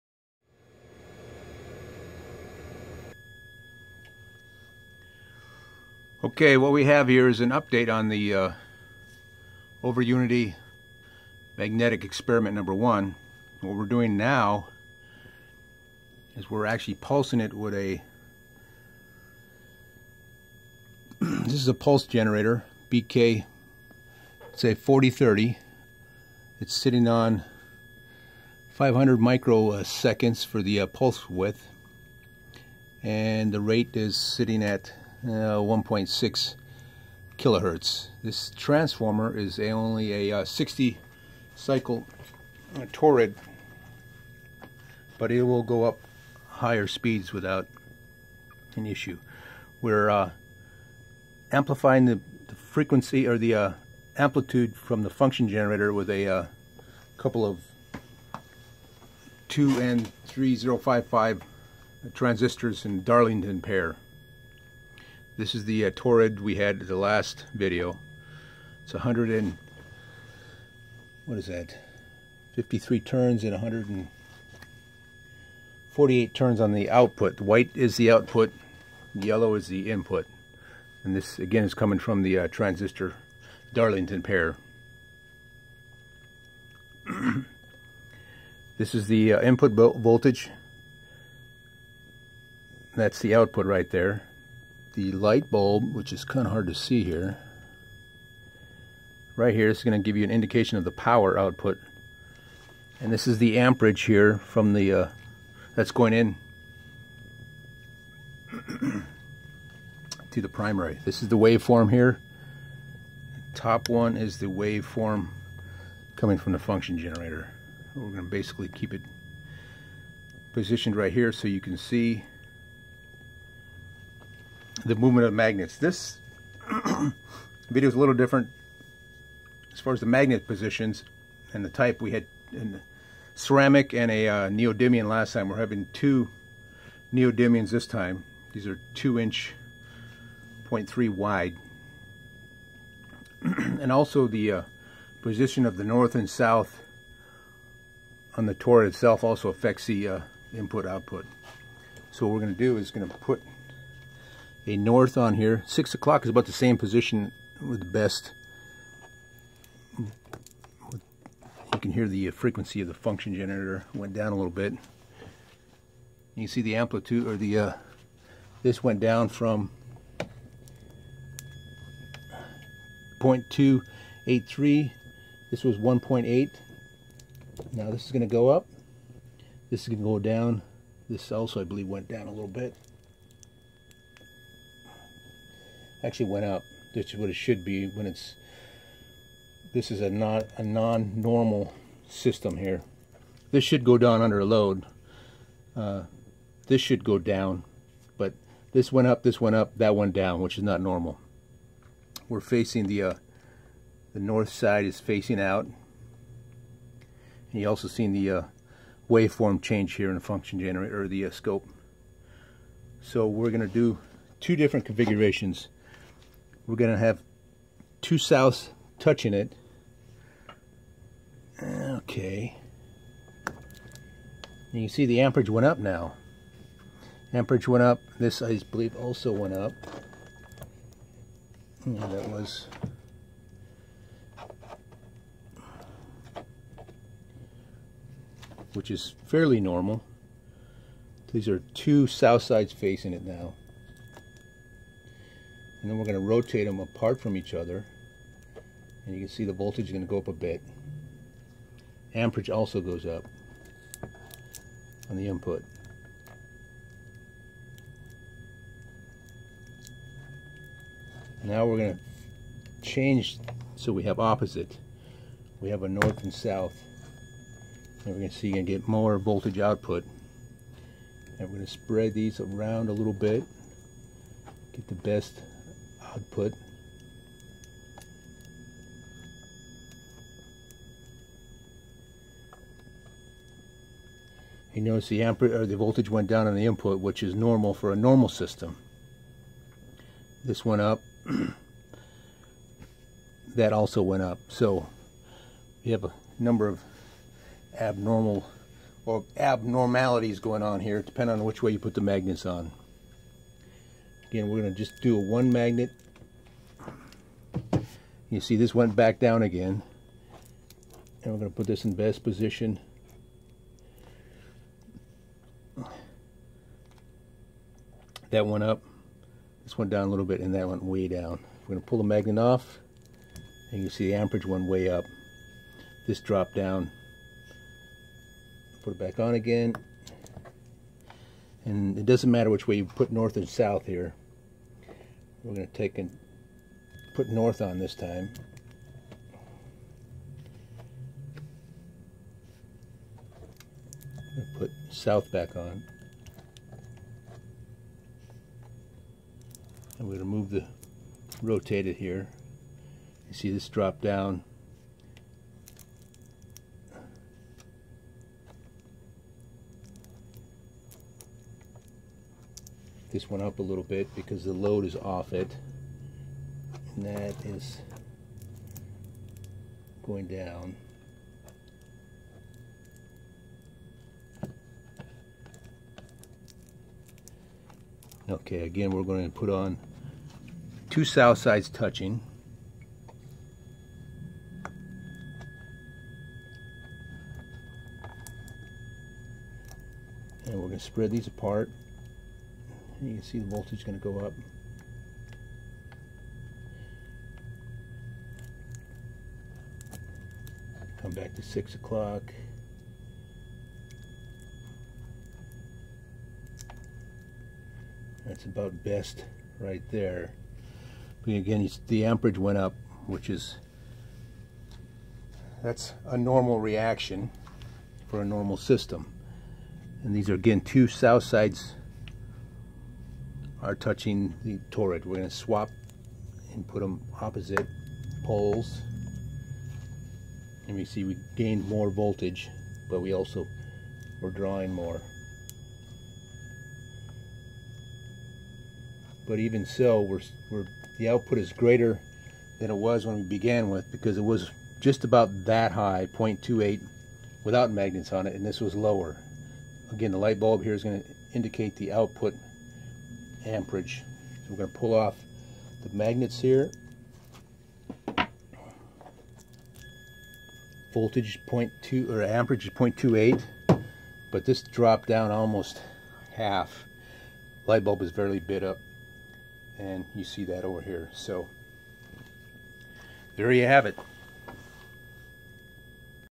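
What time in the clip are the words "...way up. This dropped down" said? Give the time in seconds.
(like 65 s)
324 s.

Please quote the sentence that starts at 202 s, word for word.
We're facing the, uh, the north side is facing out.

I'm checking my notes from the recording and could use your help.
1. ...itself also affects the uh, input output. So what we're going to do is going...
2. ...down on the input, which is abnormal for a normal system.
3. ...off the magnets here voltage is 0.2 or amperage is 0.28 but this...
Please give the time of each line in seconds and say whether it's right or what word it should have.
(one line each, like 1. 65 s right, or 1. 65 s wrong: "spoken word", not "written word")
1. 148 s right
2. 286 s wrong: "normal", not "abnormal"
3. 454 s right.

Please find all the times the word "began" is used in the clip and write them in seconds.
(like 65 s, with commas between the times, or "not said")
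443 s.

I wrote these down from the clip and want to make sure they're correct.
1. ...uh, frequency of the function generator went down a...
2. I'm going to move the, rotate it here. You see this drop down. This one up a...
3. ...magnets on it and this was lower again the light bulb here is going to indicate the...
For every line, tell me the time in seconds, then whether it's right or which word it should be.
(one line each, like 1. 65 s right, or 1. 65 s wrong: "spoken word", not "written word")
1. 162 s right
2. 349 s right
3. 447 s right.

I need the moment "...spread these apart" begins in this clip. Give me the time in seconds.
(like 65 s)
390 s.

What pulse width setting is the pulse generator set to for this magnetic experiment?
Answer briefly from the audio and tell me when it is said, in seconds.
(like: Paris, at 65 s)
500 microseconds, at 28 s.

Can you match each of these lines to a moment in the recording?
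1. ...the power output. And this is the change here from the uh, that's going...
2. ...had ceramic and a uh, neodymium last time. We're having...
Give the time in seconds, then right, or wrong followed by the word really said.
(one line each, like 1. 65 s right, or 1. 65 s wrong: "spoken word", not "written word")
1. 100 s wrong: "amperage", not "change"
2. 132 s right.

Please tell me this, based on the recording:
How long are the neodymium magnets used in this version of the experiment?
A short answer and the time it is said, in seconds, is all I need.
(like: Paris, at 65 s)
2 inches, at 138 s.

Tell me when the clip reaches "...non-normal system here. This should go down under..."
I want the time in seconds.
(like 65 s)
190 s.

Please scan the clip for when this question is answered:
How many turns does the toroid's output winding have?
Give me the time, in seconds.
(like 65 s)
73 s.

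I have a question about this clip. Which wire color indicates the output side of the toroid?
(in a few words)
White.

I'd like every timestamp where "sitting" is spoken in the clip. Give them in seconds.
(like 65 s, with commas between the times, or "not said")
26 s, 34 s.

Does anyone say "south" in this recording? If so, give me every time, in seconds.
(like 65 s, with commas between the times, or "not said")
146 s, 218 s, 242 s, 266 s, 333 s, 344 s, 381 s, 420 s.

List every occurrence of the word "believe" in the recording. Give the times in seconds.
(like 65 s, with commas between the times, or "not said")
181 s, 228 s.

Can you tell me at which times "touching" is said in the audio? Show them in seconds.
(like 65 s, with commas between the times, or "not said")
218 s, 381 s, 423 s.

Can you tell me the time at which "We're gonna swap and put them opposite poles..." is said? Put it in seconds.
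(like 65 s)
425 s.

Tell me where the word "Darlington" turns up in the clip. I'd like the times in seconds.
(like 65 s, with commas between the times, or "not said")
63 s, 83 s.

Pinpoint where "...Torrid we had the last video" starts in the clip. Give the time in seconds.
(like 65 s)
65 s.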